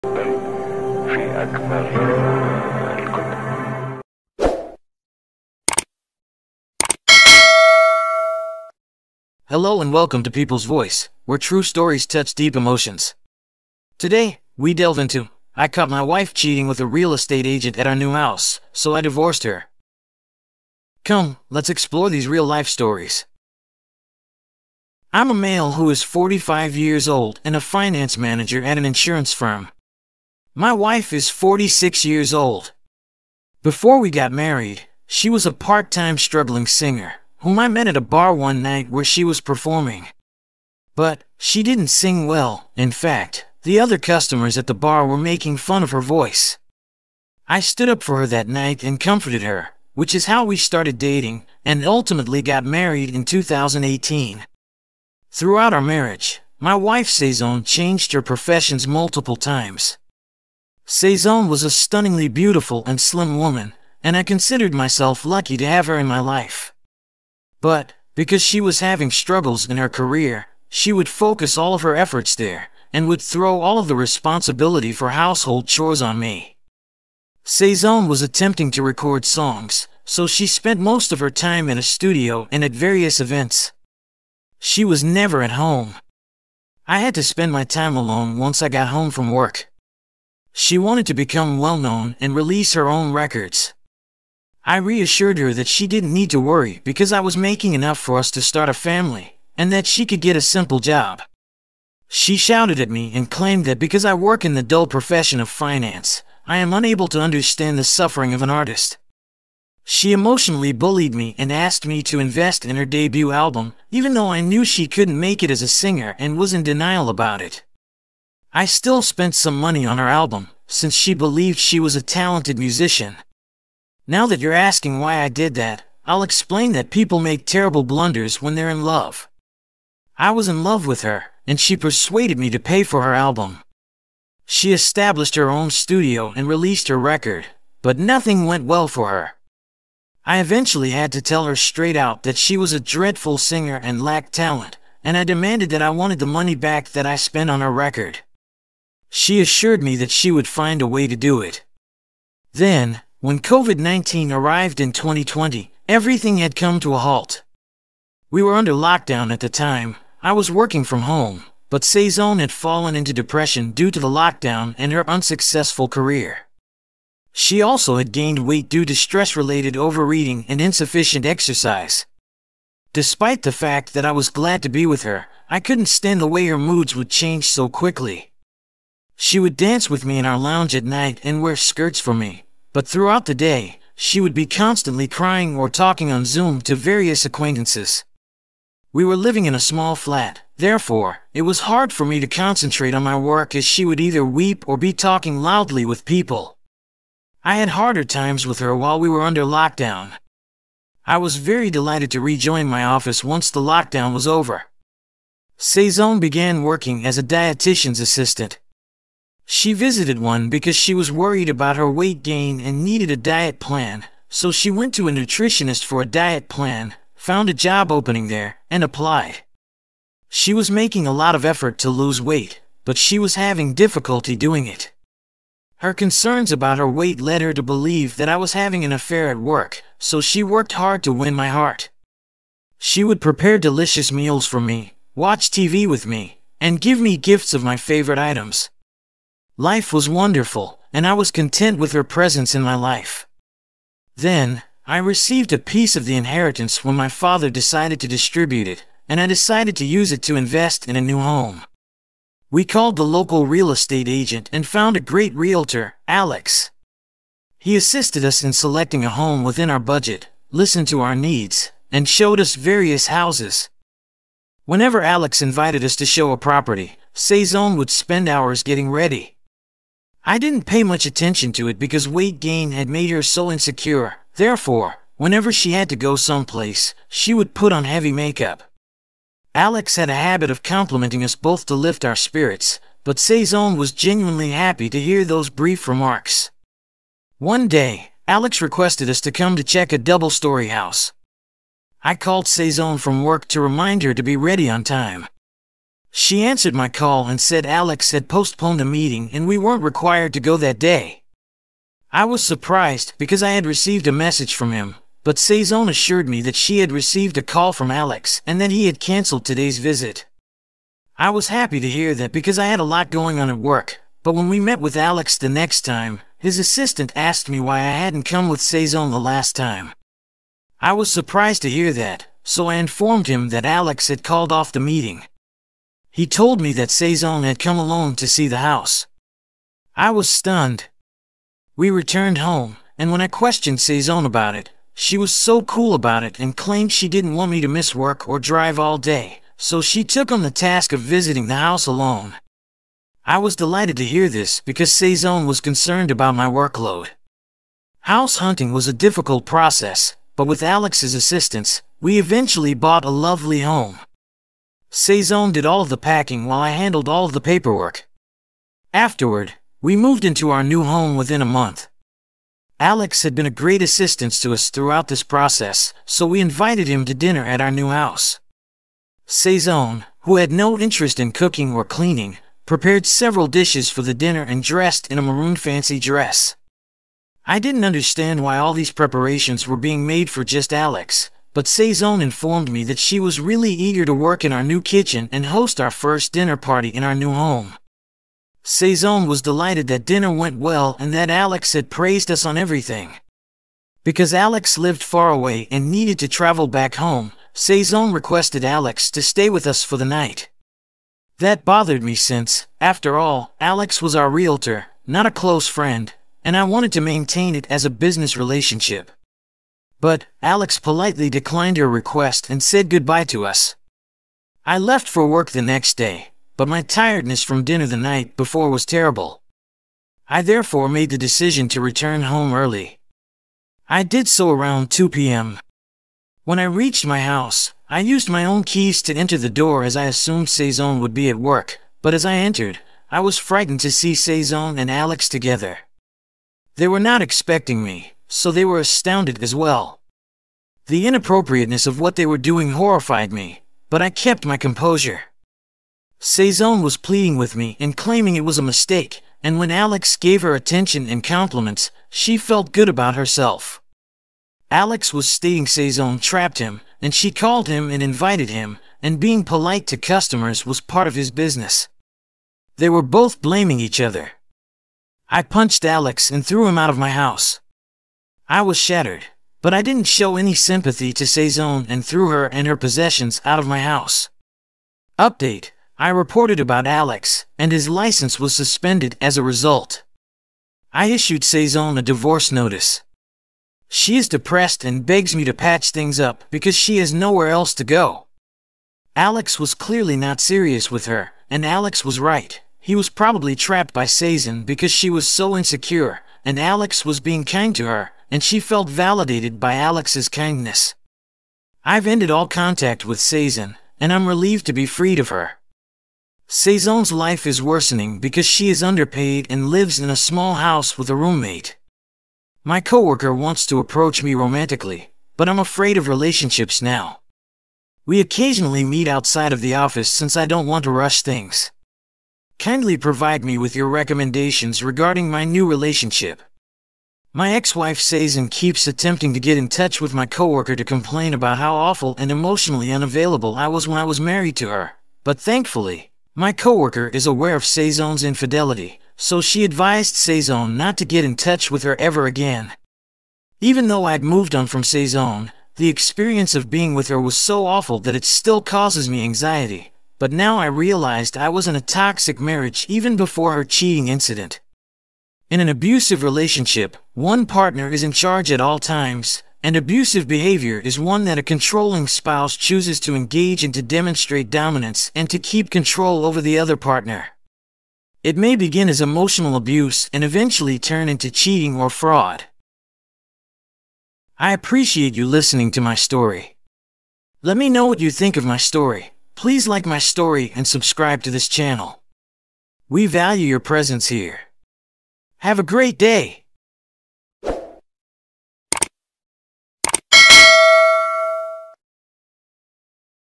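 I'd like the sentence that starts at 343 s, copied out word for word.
I was delighted to hear this because Saison was concerned about my workload.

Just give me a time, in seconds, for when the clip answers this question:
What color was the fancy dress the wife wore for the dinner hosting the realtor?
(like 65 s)
375 s.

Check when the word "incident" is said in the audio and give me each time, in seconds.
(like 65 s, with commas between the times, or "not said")
554 s.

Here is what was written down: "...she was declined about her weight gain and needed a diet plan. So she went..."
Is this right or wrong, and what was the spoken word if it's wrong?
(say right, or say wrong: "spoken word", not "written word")
wrong: "worried", not "declined".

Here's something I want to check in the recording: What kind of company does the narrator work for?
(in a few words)
an insurance firm.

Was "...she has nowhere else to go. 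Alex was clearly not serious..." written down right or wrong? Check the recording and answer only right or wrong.
right.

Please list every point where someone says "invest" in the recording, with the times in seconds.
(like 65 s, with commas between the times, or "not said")
112 s, 250 s.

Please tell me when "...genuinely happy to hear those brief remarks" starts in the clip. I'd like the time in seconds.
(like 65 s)
283 s.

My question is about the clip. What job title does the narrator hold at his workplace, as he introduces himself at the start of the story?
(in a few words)
finance manager.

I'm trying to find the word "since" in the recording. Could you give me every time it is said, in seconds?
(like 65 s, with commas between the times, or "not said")
120 s, 402 s, 520 s.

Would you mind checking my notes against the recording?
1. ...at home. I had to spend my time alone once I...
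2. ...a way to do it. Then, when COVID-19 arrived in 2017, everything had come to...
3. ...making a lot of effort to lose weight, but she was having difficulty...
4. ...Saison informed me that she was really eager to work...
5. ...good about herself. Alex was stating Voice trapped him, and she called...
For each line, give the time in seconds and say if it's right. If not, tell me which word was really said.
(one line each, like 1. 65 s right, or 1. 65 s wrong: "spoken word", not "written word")
1. 85 s right
2. 150 s wrong: "2020", not "2017"
3. 220 s right
4. 381 s right
5. 452 s wrong: "Saison", not "Voice".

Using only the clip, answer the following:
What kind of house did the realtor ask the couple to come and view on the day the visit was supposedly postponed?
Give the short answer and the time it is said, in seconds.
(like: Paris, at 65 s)
double-story house, at 289 s.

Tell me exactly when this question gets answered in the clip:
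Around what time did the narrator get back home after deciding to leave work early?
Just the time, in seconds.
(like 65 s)
424 s.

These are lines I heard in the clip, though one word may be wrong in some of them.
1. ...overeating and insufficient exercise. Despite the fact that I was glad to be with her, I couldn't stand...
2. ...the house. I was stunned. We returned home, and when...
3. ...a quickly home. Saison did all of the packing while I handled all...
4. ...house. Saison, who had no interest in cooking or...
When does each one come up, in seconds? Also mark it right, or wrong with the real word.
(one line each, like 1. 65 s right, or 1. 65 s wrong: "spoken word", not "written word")
1. 169 s right
2. 328 s right
3. 353 s wrong: "lovely", not "quickly"
4. 367 s right.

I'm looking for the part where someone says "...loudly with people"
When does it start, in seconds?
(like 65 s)
195 s.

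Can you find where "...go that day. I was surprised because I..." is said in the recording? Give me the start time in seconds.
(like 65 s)
300 s.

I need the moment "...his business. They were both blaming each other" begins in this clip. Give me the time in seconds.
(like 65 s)
461 s.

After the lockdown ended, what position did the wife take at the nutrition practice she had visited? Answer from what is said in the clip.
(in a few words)
dietitian's assistant.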